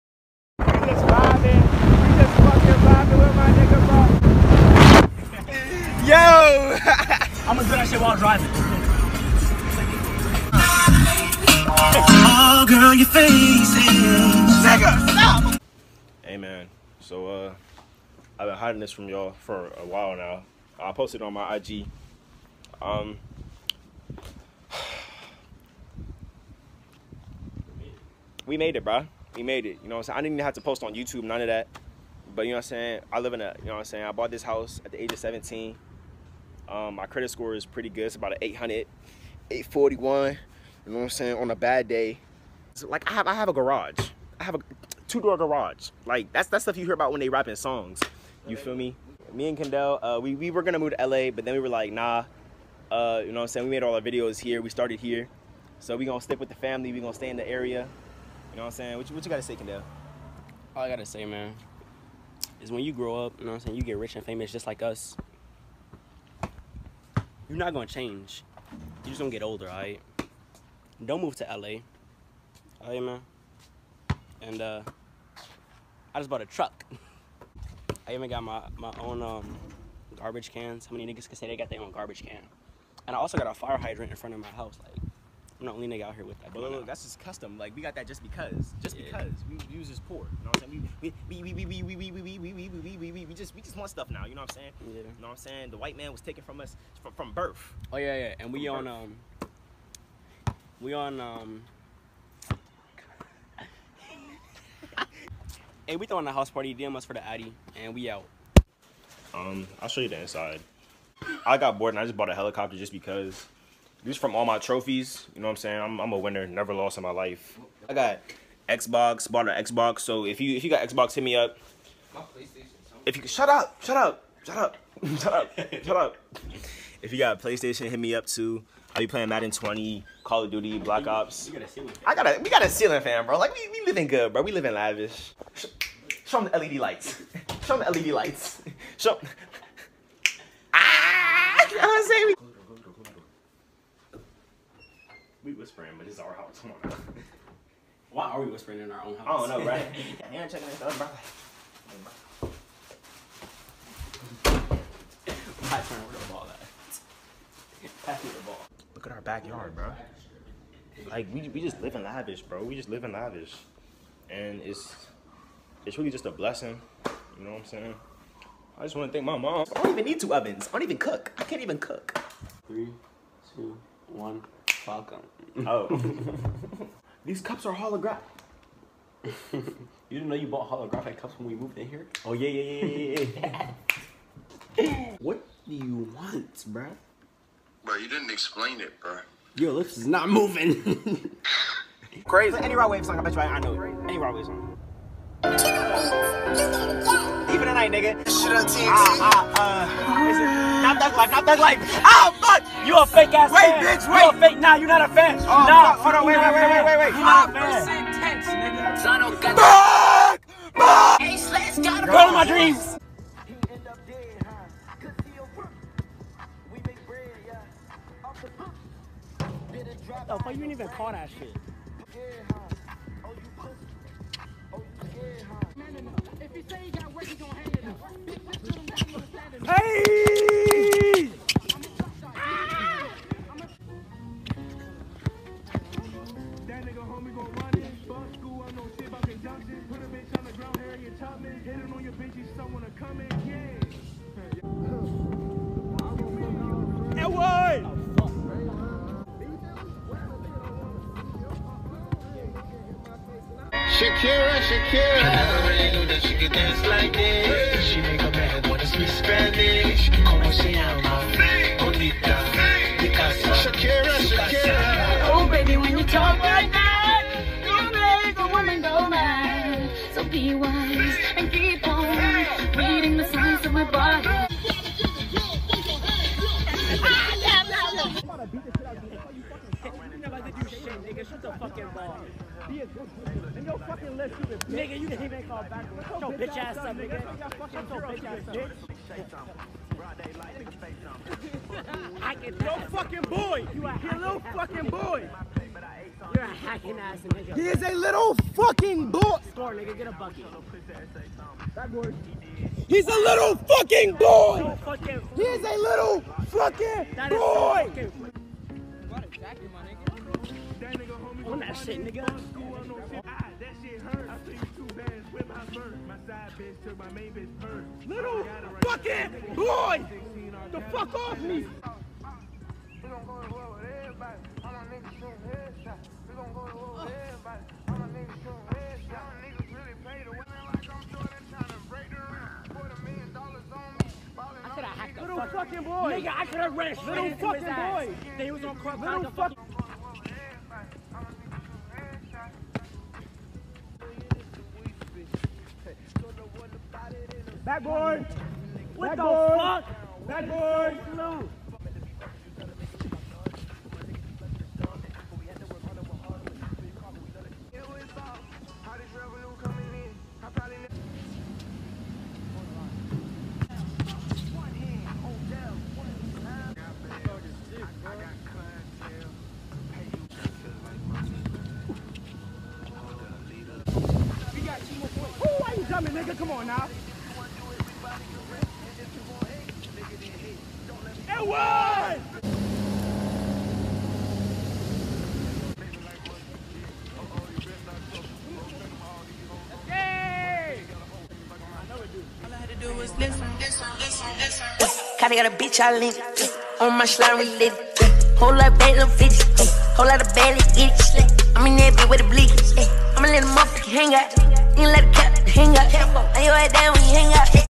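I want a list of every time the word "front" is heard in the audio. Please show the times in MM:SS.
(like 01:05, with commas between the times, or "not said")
01:24.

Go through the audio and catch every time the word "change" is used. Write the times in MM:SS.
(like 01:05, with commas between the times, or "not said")
01:07.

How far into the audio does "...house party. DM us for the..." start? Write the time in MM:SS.
01:46.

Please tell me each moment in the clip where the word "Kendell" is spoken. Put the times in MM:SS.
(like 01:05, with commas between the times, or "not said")
00:49, 00:59.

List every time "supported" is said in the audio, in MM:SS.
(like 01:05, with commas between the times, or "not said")
not said.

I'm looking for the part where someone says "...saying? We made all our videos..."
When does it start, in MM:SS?
00:53.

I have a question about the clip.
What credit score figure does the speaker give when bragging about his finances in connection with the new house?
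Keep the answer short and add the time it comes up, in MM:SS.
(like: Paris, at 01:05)
841, at 00:39.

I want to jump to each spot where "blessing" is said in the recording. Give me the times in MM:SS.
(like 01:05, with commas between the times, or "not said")
02:46.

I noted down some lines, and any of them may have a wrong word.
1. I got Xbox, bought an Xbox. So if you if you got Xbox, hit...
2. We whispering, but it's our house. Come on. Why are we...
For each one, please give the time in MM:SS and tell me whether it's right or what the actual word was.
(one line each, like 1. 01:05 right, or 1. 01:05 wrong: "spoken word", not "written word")
1. 01:57 right
2. 02:25 right.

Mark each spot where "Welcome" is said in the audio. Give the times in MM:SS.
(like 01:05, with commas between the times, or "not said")
02:54.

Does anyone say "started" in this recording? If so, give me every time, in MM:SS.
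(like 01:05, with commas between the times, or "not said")
00:54.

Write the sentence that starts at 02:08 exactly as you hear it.
I'll be playing Madden 20, Call of Duty, Black Ops.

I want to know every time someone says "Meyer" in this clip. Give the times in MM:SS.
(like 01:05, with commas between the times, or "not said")
not said.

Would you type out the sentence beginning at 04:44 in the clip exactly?
Nigga, you can not even call back.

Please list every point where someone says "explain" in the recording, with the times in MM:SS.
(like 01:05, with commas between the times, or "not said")
03:08.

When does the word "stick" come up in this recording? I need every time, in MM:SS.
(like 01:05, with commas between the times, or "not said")
00:56.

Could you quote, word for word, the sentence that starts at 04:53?
You a your little fucking boy.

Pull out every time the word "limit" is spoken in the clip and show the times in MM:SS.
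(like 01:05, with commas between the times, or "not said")
not said.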